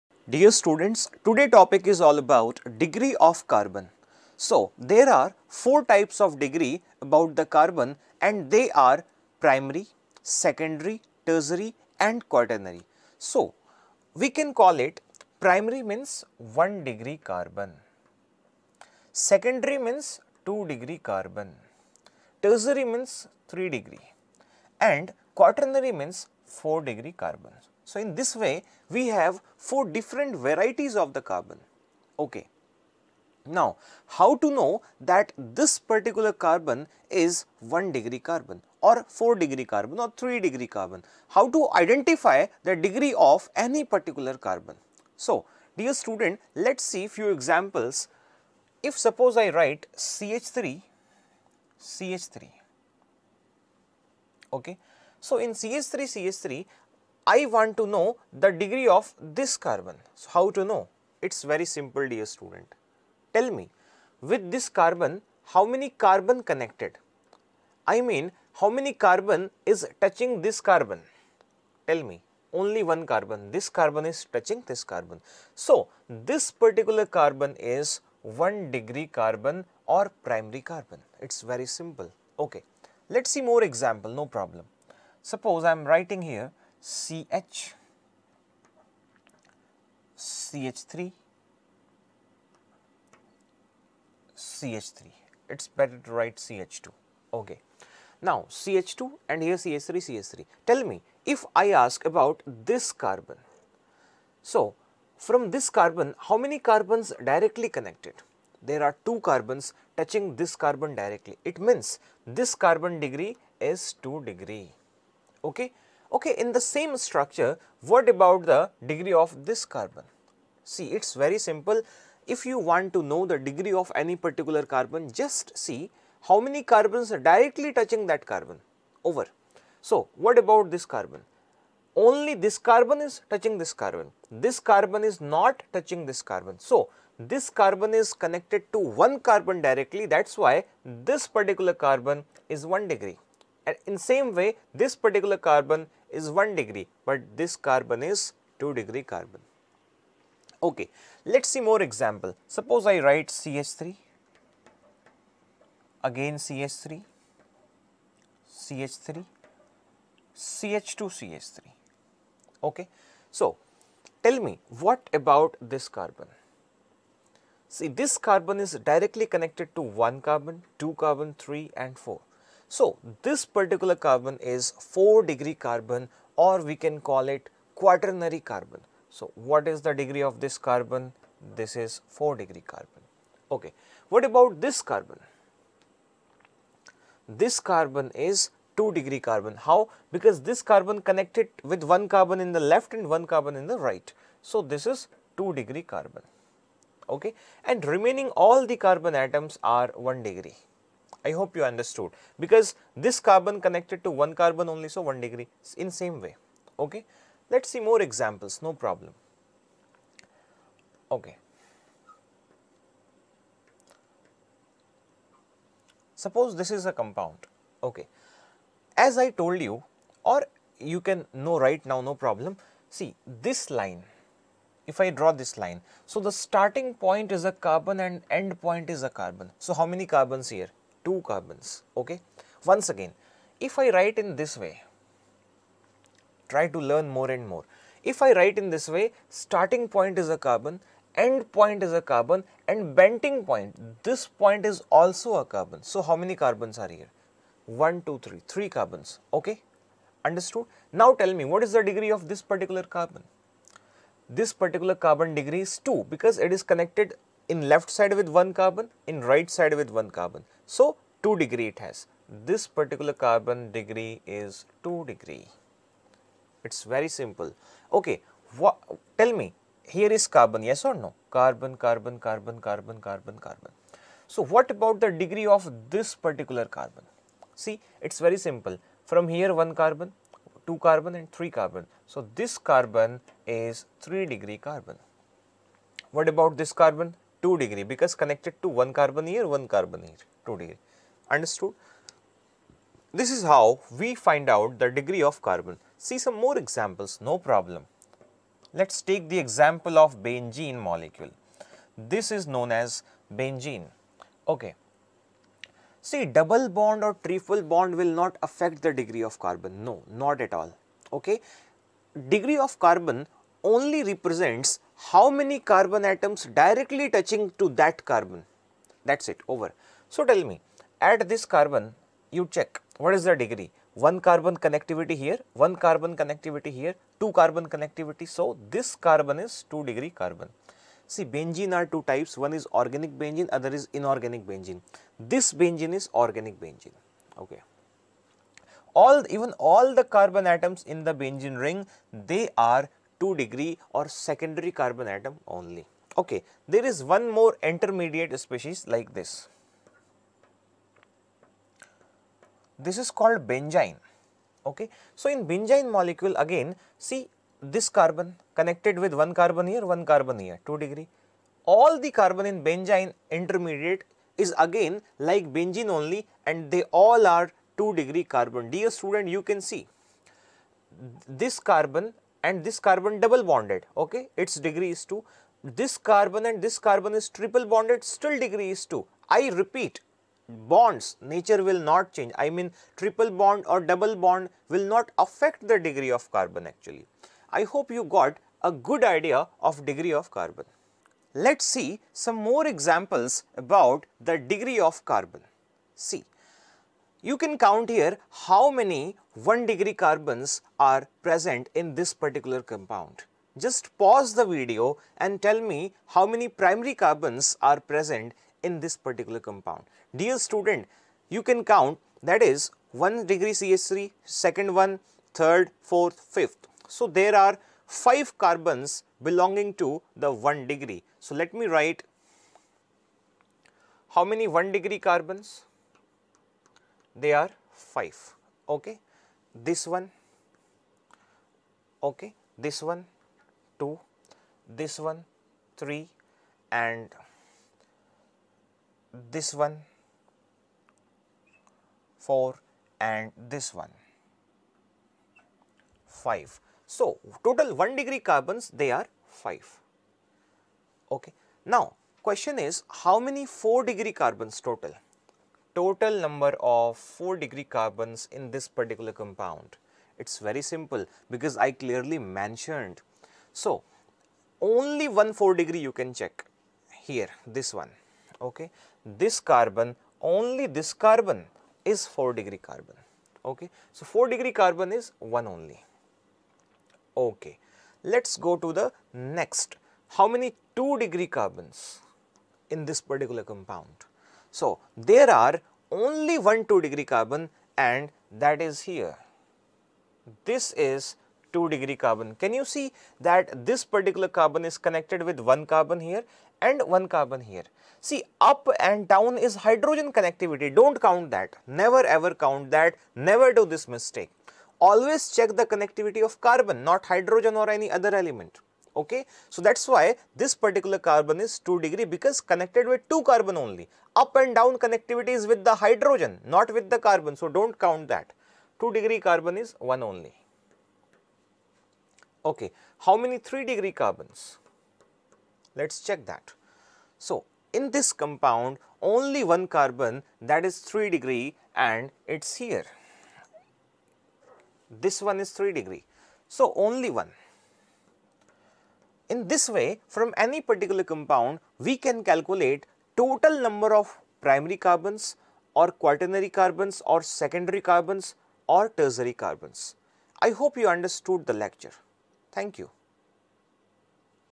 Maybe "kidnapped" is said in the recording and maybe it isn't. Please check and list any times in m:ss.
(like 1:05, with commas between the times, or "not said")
not said.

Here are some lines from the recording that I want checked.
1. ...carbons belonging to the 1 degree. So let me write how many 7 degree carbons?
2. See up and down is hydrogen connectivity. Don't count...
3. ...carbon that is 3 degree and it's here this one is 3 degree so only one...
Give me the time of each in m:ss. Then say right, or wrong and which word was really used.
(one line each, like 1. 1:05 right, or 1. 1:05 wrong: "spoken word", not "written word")
1. 6:58 wrong: "1", not "7"
2. 8:18 right
3. 8:49 right.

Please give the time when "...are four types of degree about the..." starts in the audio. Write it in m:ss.
0:05.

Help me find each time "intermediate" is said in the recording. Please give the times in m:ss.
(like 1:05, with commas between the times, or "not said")
5:47, 6:03.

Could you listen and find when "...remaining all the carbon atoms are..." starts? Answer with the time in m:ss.
3:17.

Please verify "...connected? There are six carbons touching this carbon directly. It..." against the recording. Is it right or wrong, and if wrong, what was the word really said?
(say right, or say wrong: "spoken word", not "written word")
wrong: "two", not "six".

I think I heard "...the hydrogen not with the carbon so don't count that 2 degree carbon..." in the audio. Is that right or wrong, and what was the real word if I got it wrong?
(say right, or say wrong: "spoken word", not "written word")
right.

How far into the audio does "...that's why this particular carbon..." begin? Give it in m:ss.
8:29.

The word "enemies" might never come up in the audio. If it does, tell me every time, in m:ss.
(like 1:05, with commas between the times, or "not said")
not said.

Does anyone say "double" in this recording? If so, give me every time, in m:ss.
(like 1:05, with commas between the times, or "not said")
5:06, 6:13, 6:23.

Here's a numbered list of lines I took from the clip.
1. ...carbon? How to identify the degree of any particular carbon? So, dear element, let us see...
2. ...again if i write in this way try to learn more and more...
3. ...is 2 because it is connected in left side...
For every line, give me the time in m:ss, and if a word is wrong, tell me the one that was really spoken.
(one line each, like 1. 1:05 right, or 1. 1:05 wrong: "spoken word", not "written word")
1. 0:40 wrong: "student", not "element"
2. 3:52 right
3. 4:15 right.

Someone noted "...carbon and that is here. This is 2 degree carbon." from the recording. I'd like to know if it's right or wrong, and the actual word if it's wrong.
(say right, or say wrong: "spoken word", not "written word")
right.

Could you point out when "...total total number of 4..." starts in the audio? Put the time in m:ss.
7:34.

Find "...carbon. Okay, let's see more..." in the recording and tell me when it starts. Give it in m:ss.
2:29.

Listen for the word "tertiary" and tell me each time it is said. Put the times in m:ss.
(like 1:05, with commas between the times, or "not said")
0:11, 0:22, 9:08.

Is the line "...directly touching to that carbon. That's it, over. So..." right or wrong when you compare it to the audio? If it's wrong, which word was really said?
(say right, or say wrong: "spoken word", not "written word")
right.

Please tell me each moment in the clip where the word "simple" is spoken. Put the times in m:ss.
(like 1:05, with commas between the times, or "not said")
1:01, 1:21, 2:01, 4:27, 4:38, 7:40.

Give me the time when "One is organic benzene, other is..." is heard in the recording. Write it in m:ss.
5:32.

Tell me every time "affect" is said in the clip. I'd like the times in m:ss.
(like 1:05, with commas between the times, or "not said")
5:08, 6:25.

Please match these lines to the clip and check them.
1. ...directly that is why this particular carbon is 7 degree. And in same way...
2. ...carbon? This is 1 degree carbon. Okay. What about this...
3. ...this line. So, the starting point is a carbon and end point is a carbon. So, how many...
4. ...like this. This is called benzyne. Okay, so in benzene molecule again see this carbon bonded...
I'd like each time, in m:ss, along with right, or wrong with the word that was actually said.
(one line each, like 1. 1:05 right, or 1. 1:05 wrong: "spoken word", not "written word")
1. 2:19 wrong: "1", not "7"
2. 3:00 wrong: "4", not "1"
3. 3:45 right
4. 5:48 wrong: "connected", not "bonded".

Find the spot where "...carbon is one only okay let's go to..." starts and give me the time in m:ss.
7:54.